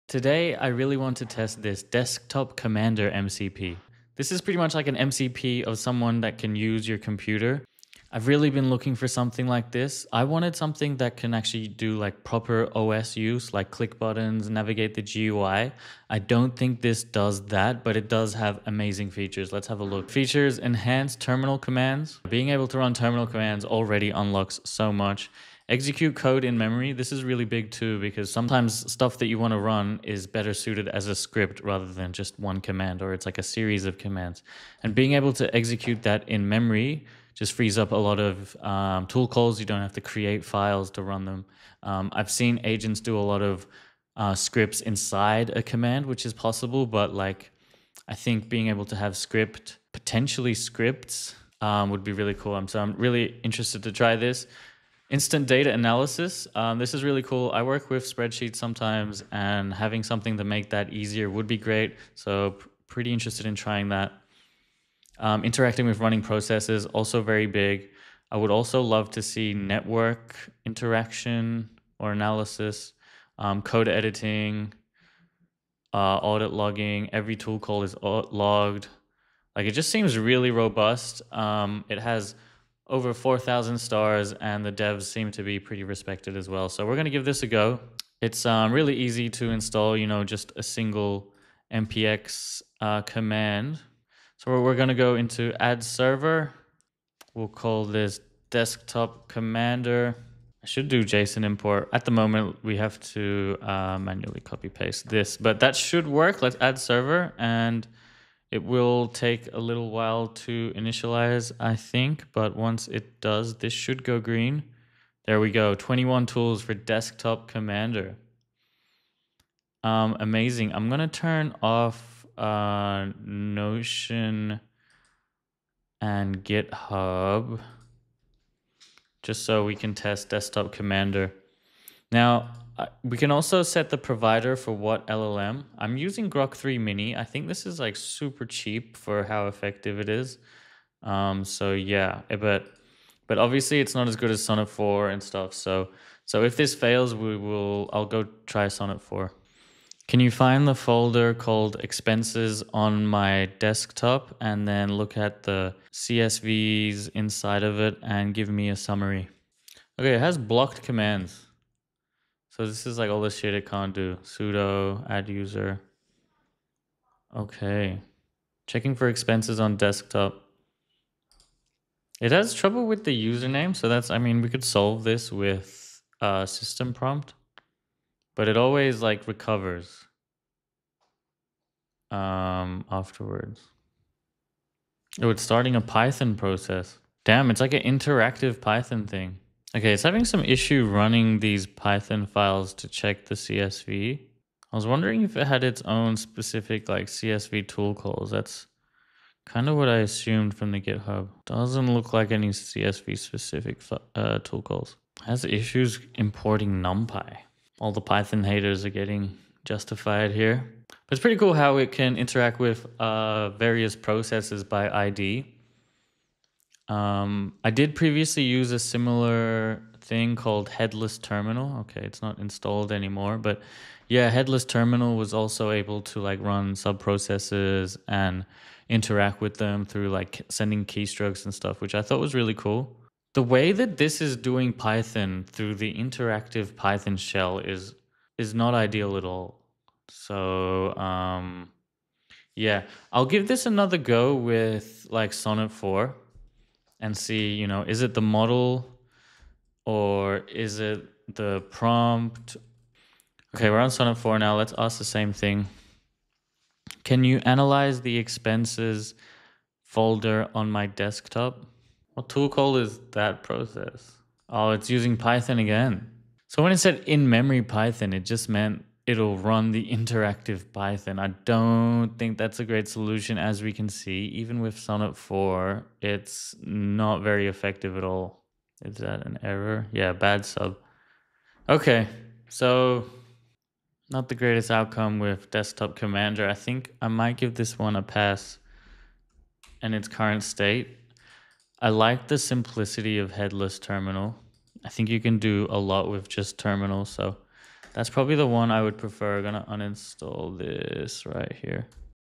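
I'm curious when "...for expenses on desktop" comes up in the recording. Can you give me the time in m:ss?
2:48.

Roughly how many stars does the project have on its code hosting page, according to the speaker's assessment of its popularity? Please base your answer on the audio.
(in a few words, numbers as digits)
4,000.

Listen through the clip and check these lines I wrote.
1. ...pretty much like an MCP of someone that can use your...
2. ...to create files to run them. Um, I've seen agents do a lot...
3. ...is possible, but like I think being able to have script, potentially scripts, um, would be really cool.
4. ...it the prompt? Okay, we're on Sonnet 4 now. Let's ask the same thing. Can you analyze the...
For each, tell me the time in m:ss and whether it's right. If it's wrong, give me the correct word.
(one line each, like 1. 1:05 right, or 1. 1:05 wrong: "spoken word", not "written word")
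1. 0:04 right
2. 0:39 right
3. 0:46 right
4. 4:10 right.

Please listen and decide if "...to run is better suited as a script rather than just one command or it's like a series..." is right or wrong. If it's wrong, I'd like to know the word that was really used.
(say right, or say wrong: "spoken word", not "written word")
right.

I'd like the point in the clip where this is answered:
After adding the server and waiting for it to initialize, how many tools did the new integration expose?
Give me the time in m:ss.
1:55.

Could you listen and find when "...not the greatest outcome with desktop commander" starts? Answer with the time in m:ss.
4:44.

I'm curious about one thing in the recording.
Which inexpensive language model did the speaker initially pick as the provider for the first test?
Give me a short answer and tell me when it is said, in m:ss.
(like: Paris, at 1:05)
Grok 3 Mini, at 2:16.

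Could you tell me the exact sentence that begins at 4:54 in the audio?
I think you can do a lot with just terminal, so...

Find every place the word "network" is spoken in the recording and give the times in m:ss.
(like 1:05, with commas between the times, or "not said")
1:09.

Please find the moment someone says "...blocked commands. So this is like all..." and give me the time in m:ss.
2:40.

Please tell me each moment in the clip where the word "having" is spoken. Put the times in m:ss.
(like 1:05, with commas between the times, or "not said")
0:59, 3:10.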